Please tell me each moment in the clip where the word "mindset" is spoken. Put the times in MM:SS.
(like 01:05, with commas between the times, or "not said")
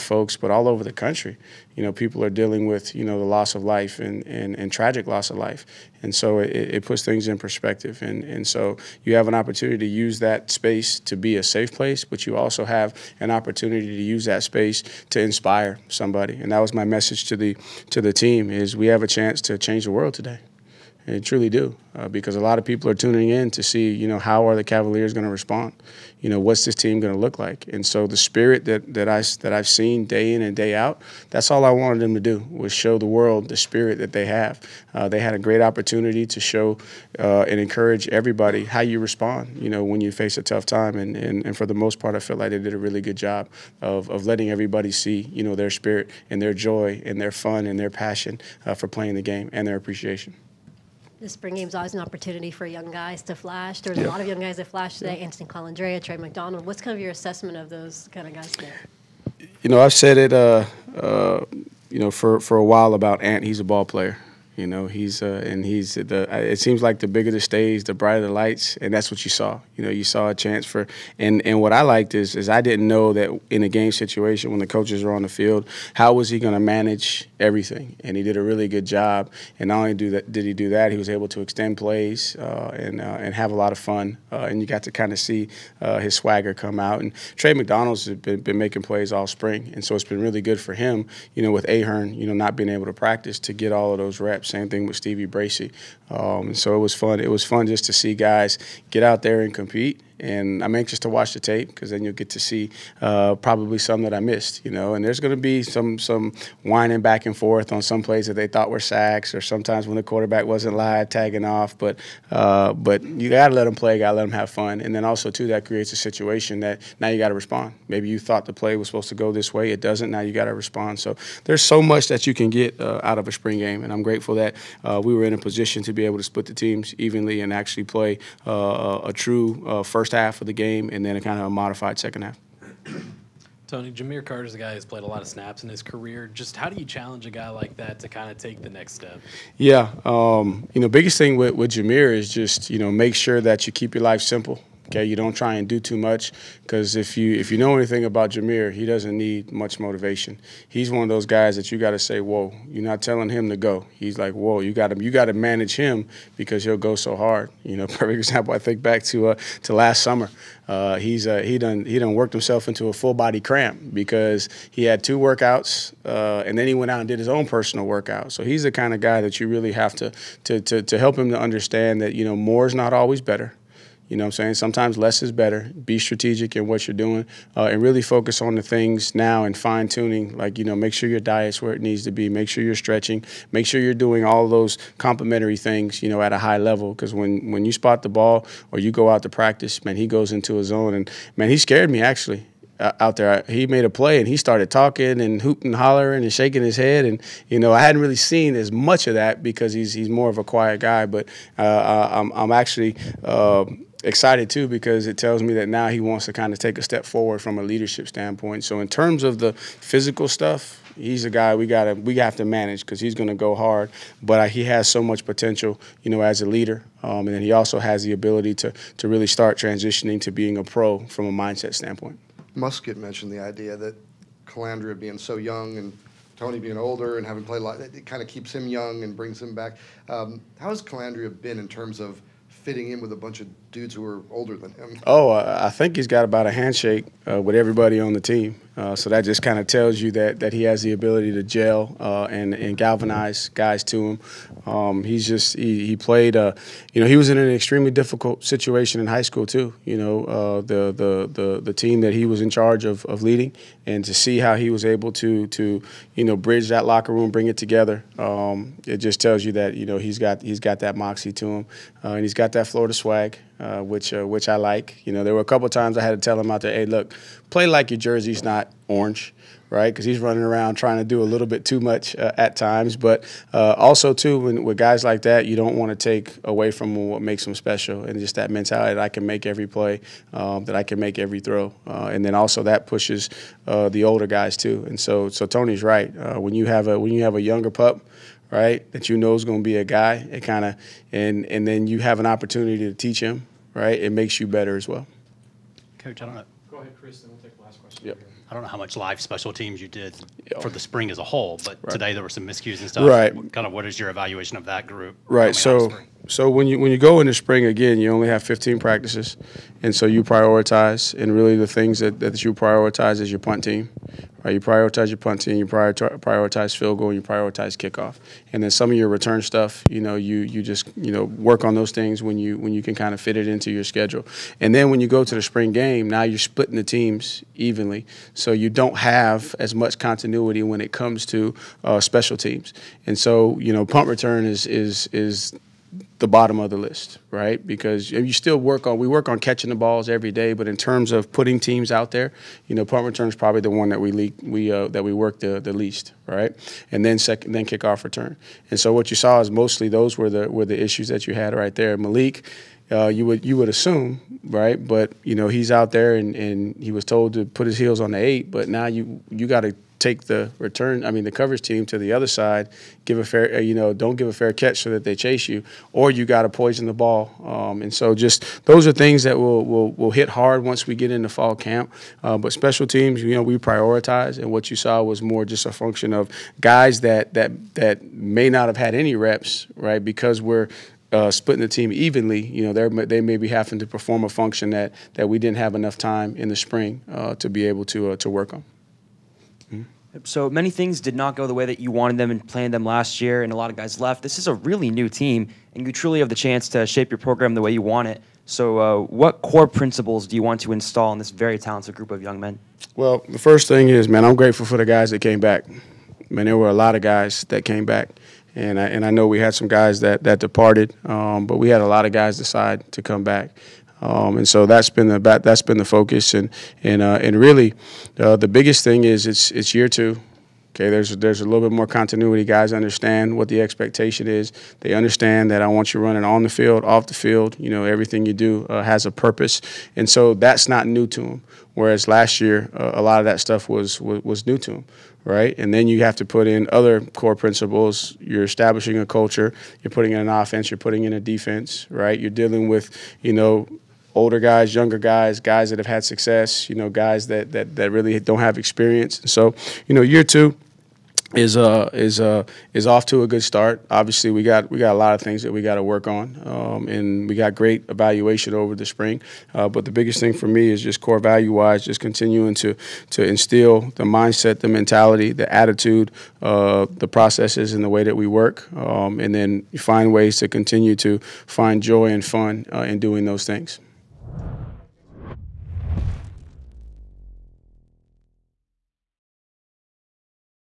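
03:41, 07:44.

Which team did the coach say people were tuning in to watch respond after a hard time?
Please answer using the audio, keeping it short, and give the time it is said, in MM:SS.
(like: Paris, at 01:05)
Cavaliers, at 00:24.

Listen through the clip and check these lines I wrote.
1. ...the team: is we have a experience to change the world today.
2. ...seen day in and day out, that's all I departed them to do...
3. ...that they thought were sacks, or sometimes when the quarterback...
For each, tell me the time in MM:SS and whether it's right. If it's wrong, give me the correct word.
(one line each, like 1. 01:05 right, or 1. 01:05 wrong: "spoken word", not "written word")
1. 00:18 wrong: "chance", not "experience"
2. 00:29 wrong: "wanted", not "departed"
3. 01:48 right.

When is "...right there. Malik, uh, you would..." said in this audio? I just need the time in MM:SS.
05:51.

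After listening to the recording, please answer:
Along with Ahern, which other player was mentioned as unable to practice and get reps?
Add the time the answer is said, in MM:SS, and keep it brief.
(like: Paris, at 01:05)
Stevie Bracy, at 01:34.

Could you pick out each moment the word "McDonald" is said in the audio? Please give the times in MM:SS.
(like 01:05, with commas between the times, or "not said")
00:56, 01:27.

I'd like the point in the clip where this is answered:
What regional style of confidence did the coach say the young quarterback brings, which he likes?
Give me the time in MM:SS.
04:22.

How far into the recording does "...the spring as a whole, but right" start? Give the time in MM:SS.
05:00.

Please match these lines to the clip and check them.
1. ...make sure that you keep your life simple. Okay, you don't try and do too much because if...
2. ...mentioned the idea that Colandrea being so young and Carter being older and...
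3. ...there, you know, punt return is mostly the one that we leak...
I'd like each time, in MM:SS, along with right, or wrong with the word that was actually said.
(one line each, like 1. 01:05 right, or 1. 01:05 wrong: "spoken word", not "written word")
1. 02:22 right
2. 03:42 wrong: "Tony", not "Carter"
3. 05:42 wrong: "probably", not "mostly".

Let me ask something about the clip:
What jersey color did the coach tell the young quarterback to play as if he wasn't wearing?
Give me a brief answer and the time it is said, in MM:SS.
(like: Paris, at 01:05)
Orange, at 04:28.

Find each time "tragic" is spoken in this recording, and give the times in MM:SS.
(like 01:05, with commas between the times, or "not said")
00:04.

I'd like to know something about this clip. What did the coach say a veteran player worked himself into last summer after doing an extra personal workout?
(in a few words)
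A full body cramp.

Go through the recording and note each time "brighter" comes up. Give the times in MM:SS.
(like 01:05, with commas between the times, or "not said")
01:07.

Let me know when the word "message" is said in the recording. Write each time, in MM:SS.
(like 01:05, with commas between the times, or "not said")
00:16.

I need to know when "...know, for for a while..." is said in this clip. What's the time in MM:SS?
01:01.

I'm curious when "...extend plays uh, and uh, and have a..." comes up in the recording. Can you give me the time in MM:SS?
01:21.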